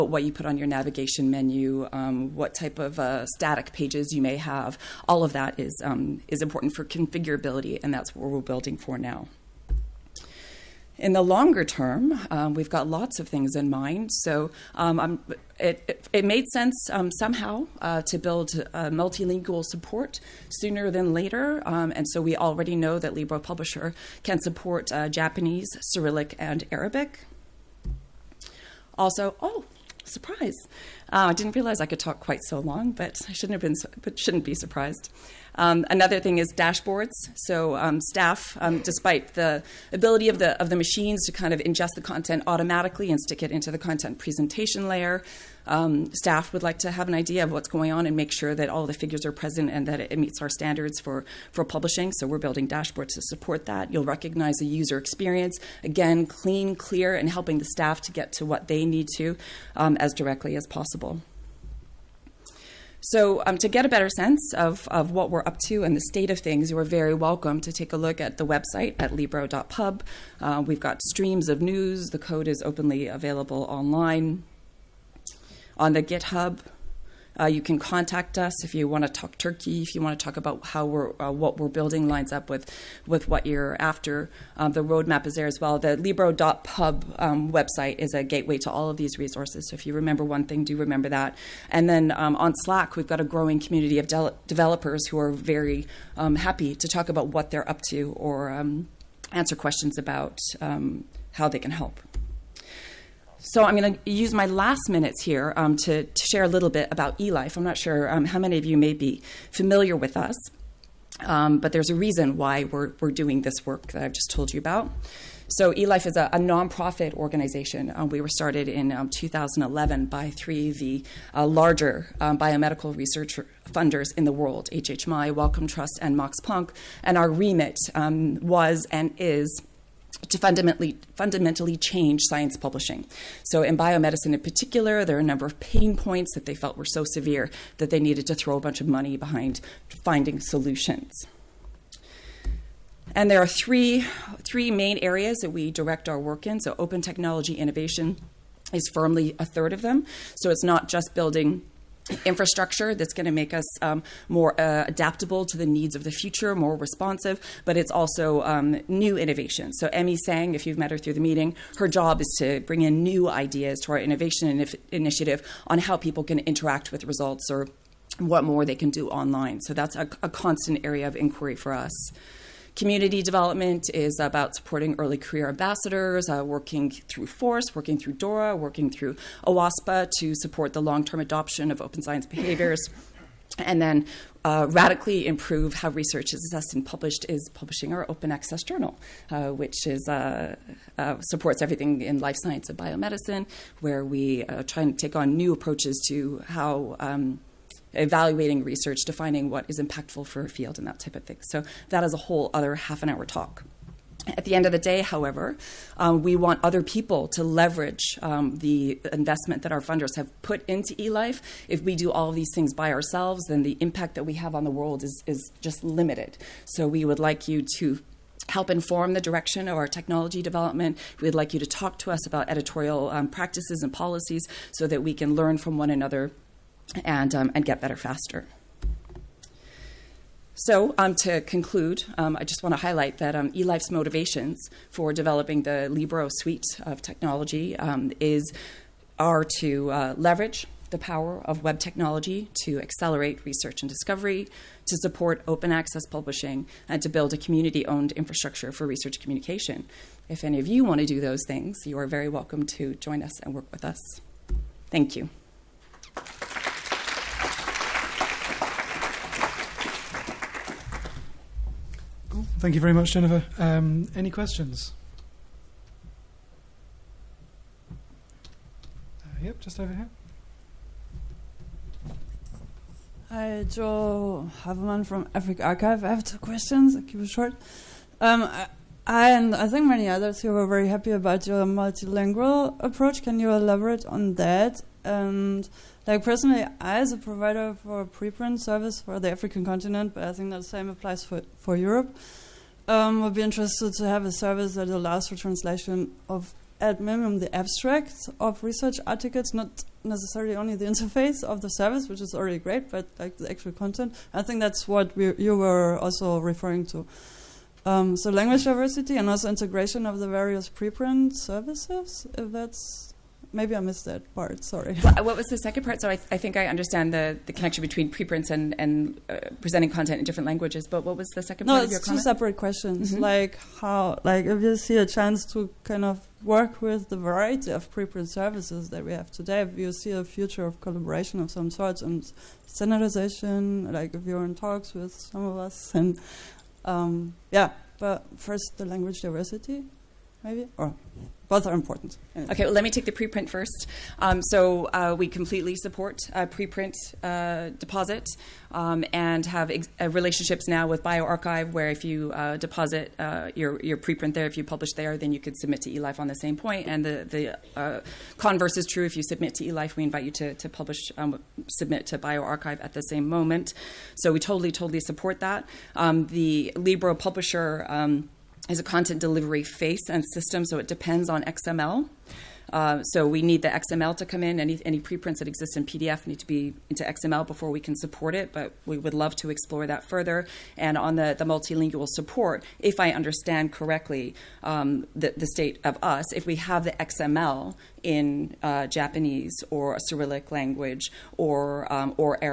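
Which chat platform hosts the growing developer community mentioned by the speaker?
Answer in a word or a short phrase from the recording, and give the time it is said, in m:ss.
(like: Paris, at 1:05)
Slack, at 1:32.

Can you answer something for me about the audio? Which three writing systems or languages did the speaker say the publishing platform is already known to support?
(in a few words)
Japanese, Cyrillic, and Arabic.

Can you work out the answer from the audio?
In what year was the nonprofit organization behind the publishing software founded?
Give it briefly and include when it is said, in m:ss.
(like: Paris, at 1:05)
2011, at 1:59.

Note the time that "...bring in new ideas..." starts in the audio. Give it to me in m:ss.
2:42.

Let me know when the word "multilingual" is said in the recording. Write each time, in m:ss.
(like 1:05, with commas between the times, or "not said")
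0:18, 4:41, 6:21.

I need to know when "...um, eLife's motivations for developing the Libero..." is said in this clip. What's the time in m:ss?
3:53.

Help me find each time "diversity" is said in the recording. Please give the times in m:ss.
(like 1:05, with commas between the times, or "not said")
5:08, 5:39.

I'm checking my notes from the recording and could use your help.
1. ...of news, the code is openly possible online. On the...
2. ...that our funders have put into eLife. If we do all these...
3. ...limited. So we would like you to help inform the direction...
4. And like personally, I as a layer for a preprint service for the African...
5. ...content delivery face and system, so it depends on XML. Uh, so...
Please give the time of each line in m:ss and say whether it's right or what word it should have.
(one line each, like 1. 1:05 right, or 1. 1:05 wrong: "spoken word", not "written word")
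1. 1:11 wrong: "available", not "possible"
2. 3:29 right
3. 3:35 right
4. 4:45 wrong: "provider", not "layer"
5. 6:08 right.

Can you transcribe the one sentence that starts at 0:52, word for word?
So we're building dashboards to support that.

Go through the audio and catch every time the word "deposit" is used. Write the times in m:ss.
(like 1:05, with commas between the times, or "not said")
5:47, 5:52.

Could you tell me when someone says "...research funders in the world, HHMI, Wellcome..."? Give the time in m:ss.
2:02.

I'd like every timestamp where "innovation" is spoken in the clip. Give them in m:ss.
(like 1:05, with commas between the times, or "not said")
2:27, 2:39, 2:43.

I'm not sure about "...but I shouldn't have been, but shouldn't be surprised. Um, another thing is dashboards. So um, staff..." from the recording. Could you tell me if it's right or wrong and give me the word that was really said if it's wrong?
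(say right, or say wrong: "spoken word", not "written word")
right.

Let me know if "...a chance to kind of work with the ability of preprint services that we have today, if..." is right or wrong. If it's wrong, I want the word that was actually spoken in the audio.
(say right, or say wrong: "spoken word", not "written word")
wrong: "variety", not "ability".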